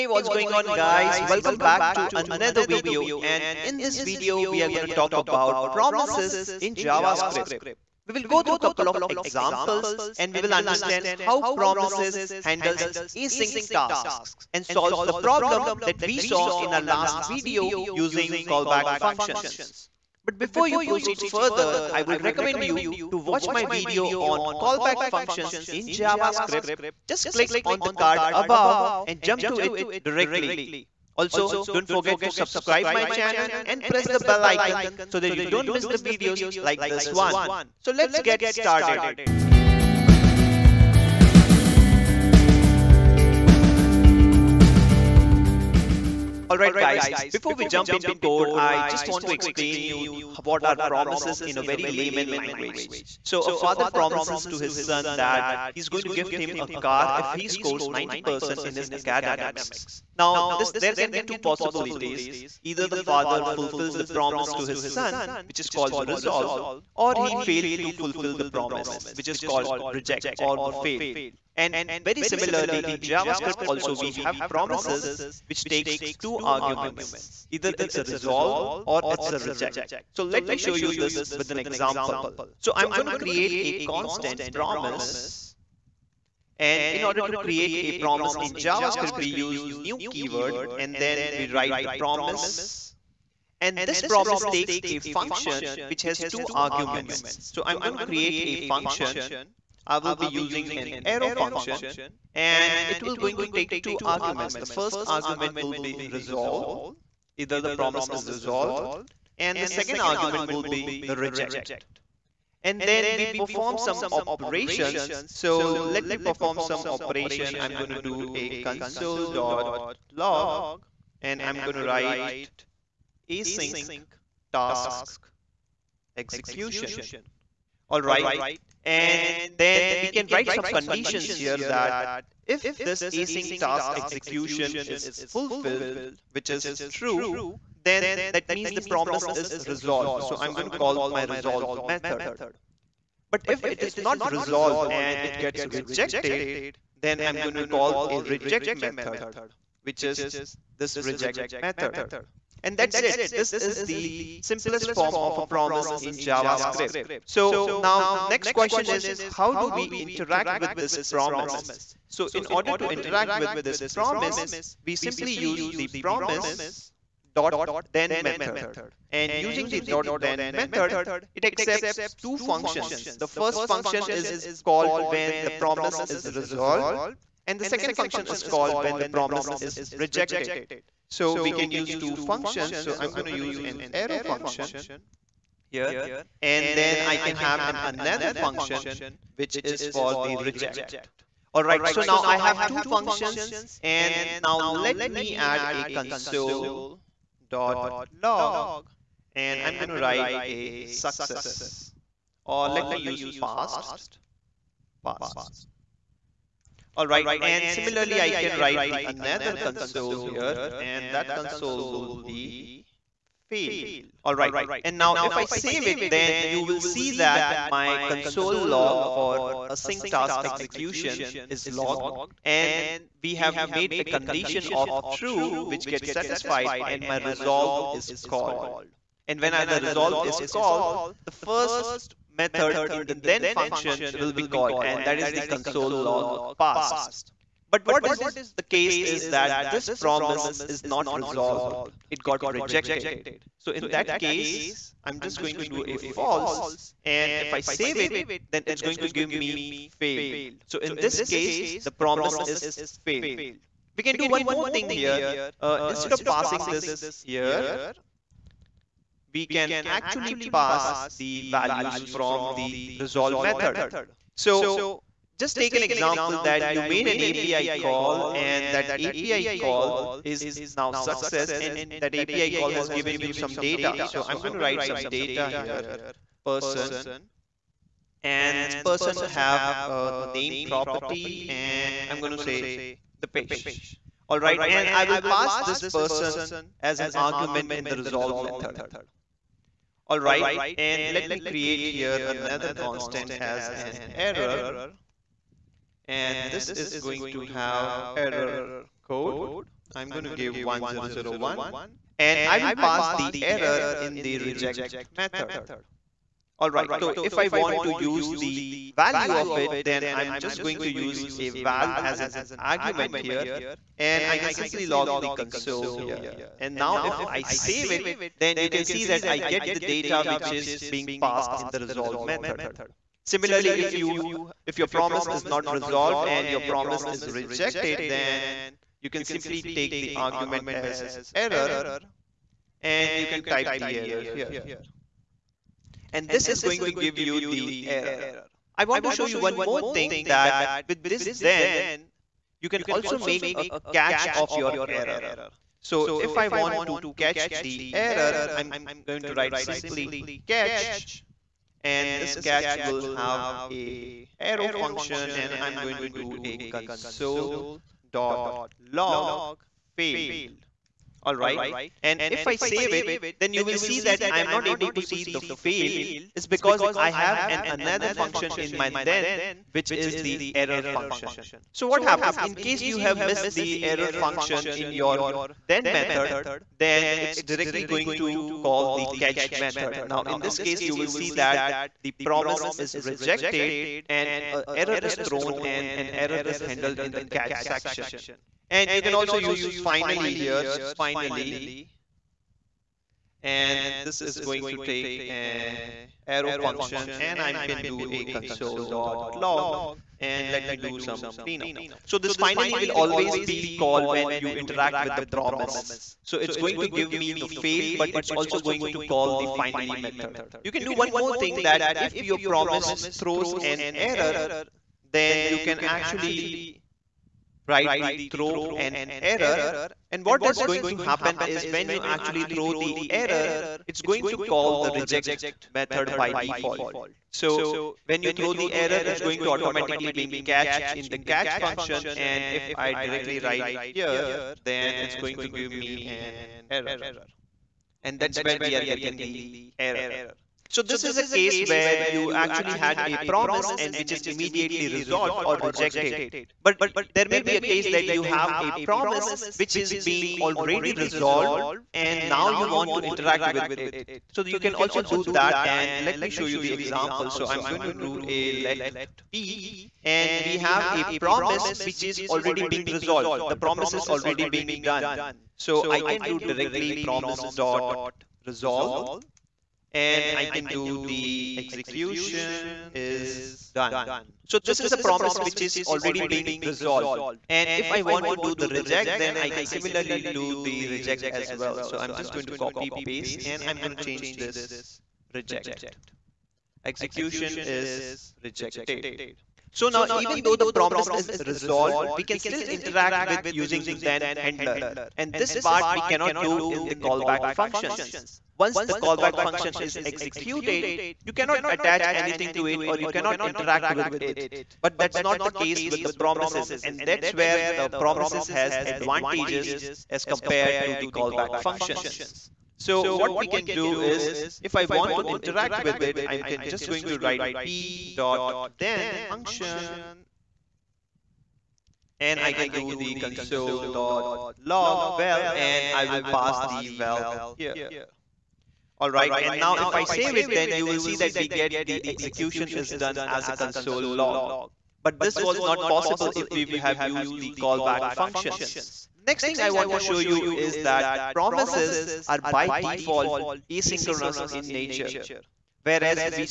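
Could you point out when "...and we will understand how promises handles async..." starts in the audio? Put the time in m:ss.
0:10.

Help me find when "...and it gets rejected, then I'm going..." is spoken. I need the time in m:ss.
2:24.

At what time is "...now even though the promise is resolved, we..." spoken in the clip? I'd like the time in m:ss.
8:09.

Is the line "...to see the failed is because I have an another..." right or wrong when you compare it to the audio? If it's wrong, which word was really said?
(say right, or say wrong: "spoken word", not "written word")
right.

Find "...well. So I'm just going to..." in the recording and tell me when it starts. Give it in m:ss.
8:01.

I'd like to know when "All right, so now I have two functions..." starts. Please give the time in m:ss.
3:11.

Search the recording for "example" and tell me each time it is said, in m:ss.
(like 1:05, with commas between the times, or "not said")
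0:09, 1:21, 4:25, 7:36.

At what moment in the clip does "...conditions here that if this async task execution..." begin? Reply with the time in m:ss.
2:10.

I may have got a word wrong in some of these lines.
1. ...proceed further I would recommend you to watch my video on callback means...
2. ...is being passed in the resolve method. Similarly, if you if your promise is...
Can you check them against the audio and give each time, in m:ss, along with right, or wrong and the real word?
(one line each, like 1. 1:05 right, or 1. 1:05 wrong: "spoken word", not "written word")
1. 0:20 wrong: "functions", not "means"
2. 5:20 right.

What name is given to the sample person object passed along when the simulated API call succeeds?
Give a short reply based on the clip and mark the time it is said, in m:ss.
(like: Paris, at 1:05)
Dipesh, at 4:43.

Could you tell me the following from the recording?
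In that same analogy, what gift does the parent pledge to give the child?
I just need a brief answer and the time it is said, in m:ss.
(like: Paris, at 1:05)
a car, at 0:56.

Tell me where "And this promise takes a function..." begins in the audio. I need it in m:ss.
1:33.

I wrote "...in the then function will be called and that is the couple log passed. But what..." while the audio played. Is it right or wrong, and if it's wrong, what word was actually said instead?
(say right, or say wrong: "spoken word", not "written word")
wrong: "console", not "couple".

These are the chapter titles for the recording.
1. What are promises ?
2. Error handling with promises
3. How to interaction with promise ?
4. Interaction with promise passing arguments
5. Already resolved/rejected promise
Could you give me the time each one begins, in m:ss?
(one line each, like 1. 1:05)
1. 0:46
2. 5:23
3. 2:39
4. 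4:14
5. 7:27.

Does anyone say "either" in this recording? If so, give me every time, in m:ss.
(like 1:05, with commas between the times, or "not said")
1:02, 1:17, 1:47.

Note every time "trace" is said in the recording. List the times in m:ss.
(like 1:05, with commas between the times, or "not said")
not said.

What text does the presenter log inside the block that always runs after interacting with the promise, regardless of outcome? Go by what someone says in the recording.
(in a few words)
cleanup.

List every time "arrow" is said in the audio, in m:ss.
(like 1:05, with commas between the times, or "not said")
1:41, 3:03, 5:54, 6:36.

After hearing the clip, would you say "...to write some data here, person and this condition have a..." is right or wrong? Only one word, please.
wrong.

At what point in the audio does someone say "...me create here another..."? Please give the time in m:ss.
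4:51.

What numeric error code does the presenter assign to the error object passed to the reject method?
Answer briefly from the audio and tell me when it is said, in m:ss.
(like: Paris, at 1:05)
1001, at 5:00.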